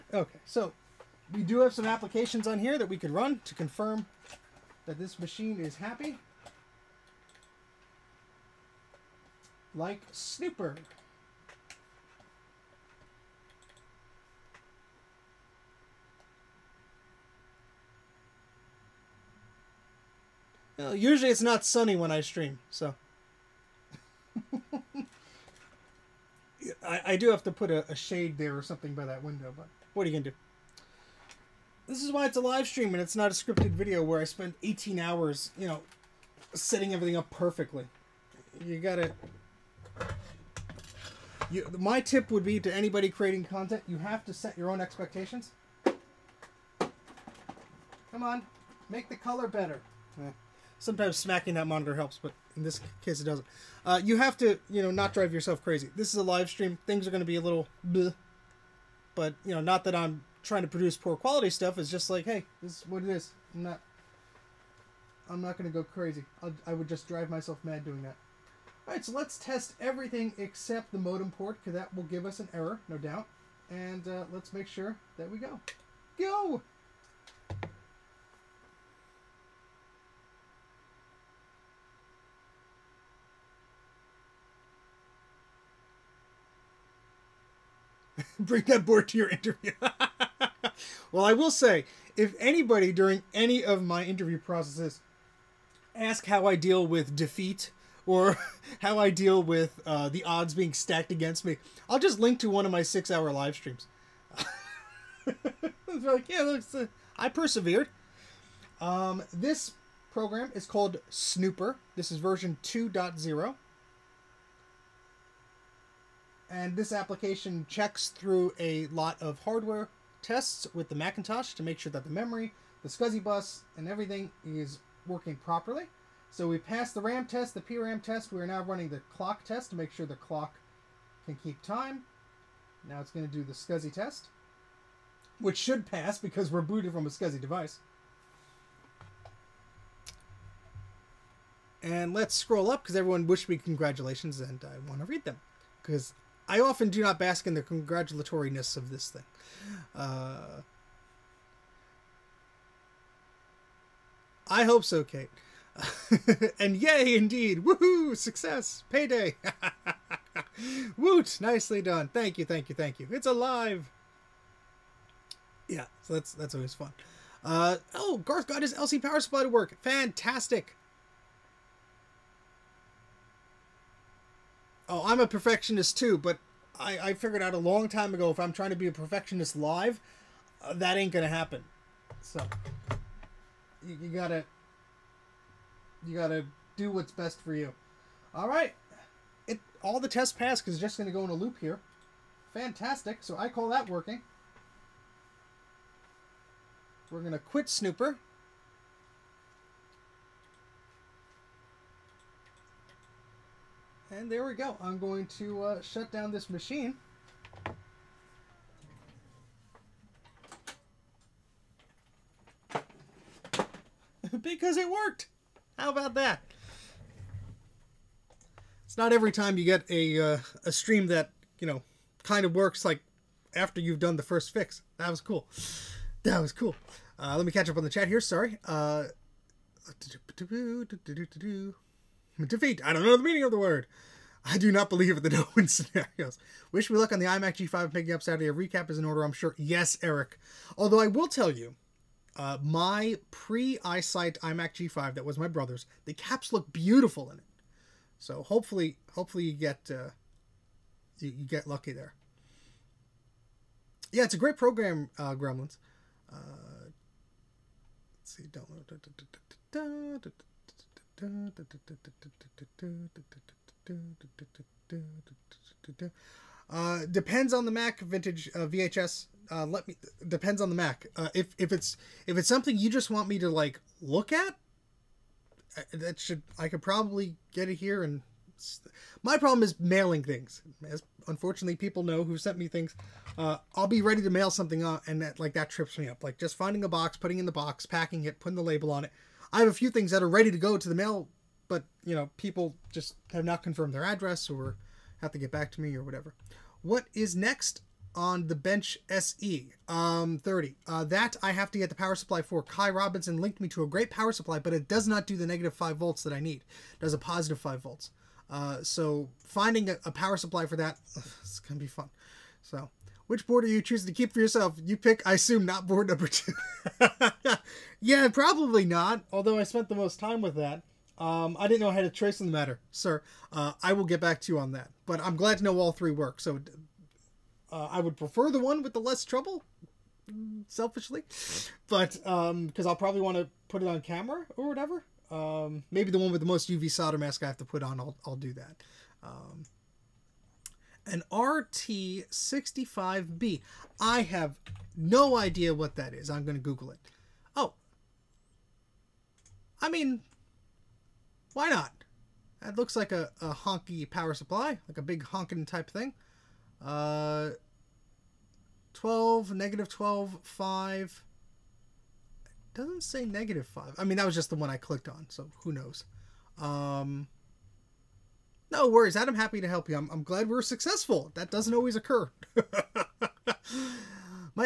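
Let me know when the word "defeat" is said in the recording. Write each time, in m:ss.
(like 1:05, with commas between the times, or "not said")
1:37, 3:52.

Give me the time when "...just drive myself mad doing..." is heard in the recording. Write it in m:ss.
1:06.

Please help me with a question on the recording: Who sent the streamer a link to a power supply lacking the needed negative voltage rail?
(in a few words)
Kai Robinson.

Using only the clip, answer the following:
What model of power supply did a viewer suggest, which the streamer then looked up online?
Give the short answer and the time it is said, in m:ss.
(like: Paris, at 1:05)
RT65B, at 5:41.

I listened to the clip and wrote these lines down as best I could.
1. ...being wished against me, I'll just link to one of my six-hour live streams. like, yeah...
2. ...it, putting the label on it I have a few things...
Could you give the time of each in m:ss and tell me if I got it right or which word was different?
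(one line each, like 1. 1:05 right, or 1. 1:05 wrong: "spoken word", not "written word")
1. 1:40 wrong: "stacked", not "wished"
2. 4:48 right.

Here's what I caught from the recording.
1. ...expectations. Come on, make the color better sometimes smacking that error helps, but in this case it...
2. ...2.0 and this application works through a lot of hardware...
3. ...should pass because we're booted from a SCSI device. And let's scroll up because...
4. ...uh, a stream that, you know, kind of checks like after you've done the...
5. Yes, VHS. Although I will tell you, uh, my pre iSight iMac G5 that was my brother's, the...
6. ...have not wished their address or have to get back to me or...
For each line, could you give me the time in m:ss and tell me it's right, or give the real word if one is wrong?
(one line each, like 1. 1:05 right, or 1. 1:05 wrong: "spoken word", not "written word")
1. 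0:44 wrong: "monitor", not "error"
2. 1:52 wrong: "checks", not "works"
3. 2:15 right
4. 3:40 wrong: "works", not "checks"
5. 3:59 wrong: "Eric", not "VHS"
6. 4:53 wrong: "confirmed", not "wished".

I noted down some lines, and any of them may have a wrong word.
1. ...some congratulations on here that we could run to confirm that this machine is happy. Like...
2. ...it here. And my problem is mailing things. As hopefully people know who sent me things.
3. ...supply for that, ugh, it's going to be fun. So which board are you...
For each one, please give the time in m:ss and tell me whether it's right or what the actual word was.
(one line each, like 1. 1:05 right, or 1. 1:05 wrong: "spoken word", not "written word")
1. 0:01 wrong: "applications", not "congratulations"
2. 4:37 wrong: "unfortunately", not "hopefully"
3. 5:10 right.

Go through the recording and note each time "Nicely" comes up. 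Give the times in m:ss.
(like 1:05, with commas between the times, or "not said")
2:41.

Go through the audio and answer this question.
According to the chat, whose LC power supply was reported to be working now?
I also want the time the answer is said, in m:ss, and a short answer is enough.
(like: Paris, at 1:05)
Garth, at 2:48.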